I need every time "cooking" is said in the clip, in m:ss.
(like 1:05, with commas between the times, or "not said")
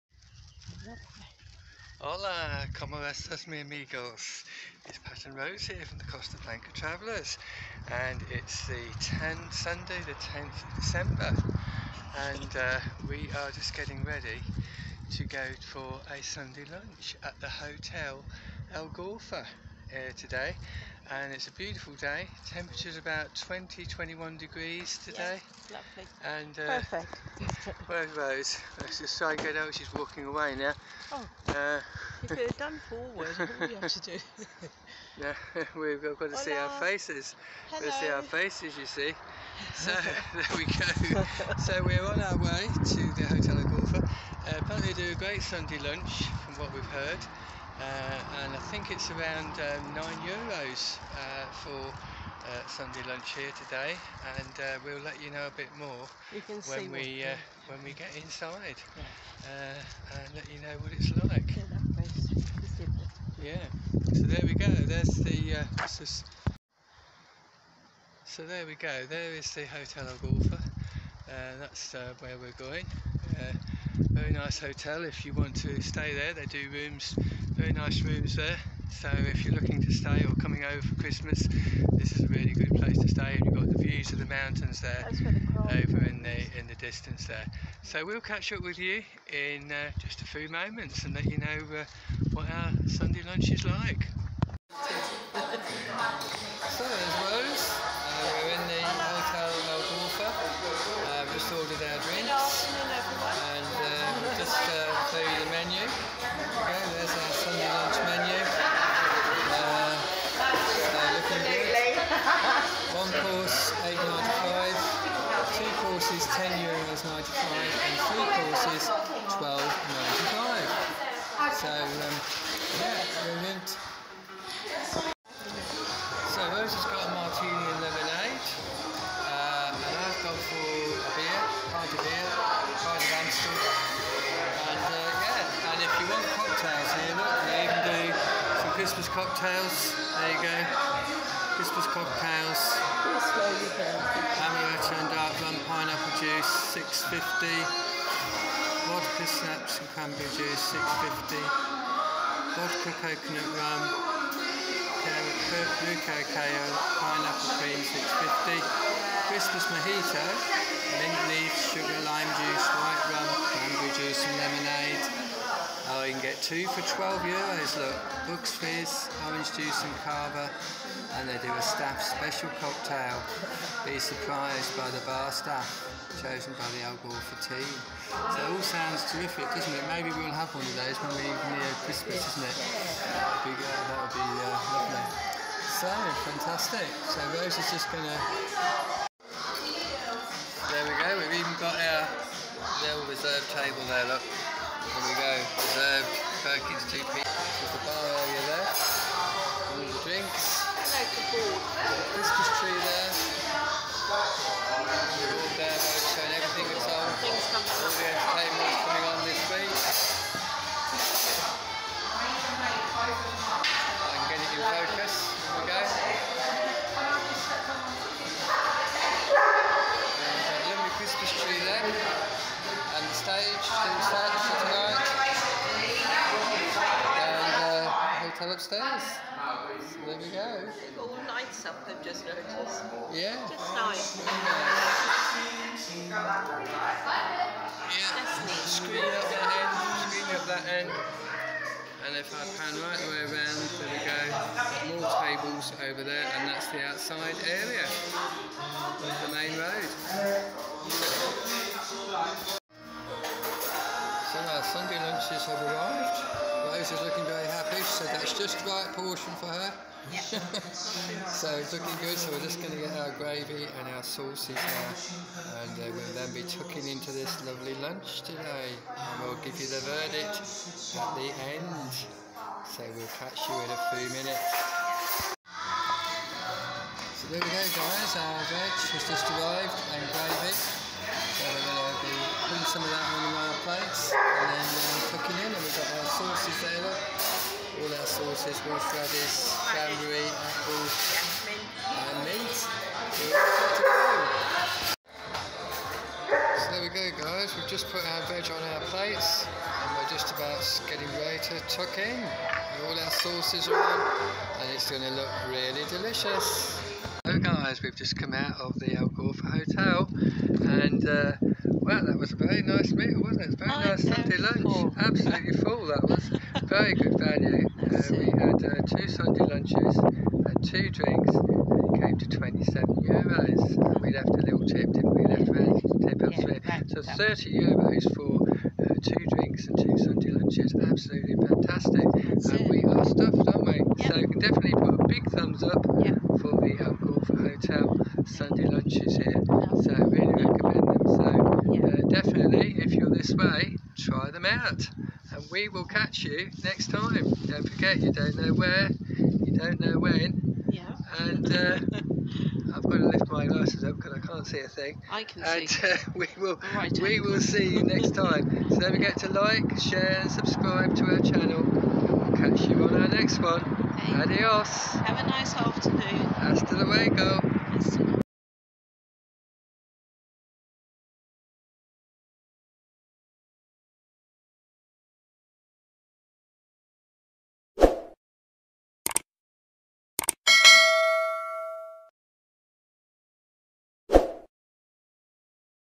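4:45.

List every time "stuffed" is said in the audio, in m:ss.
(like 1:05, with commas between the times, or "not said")
5:33.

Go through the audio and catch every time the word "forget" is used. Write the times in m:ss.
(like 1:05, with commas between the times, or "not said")
5:47, 5:58.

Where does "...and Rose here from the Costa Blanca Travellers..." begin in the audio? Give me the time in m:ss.
0:05.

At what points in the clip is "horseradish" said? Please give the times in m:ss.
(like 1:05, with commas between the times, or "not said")
4:48.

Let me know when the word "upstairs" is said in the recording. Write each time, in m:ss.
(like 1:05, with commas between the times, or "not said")
3:48.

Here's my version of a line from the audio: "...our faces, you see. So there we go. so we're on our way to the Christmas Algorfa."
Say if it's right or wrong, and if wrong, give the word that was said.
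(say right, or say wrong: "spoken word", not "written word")
wrong: "Hotel", not "Christmas".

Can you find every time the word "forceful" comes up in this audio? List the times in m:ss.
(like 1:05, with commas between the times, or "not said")
not said.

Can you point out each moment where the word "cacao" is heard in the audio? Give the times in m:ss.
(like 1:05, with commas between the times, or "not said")
2:36.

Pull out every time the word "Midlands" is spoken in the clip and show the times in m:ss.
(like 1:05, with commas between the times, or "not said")
not said.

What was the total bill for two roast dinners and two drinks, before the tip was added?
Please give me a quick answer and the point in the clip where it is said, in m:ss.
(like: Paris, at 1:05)
27 euros, at 5:22.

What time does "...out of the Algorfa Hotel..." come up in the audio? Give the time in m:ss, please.
5:08.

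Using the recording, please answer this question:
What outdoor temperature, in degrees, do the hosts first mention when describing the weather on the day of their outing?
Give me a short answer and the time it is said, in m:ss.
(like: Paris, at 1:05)
20, at 0:22.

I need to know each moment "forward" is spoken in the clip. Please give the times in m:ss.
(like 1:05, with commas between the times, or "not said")
0:32.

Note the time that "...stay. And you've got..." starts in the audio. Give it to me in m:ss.
1:23.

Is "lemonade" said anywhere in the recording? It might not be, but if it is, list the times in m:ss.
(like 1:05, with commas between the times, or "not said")
2:07, 2:44.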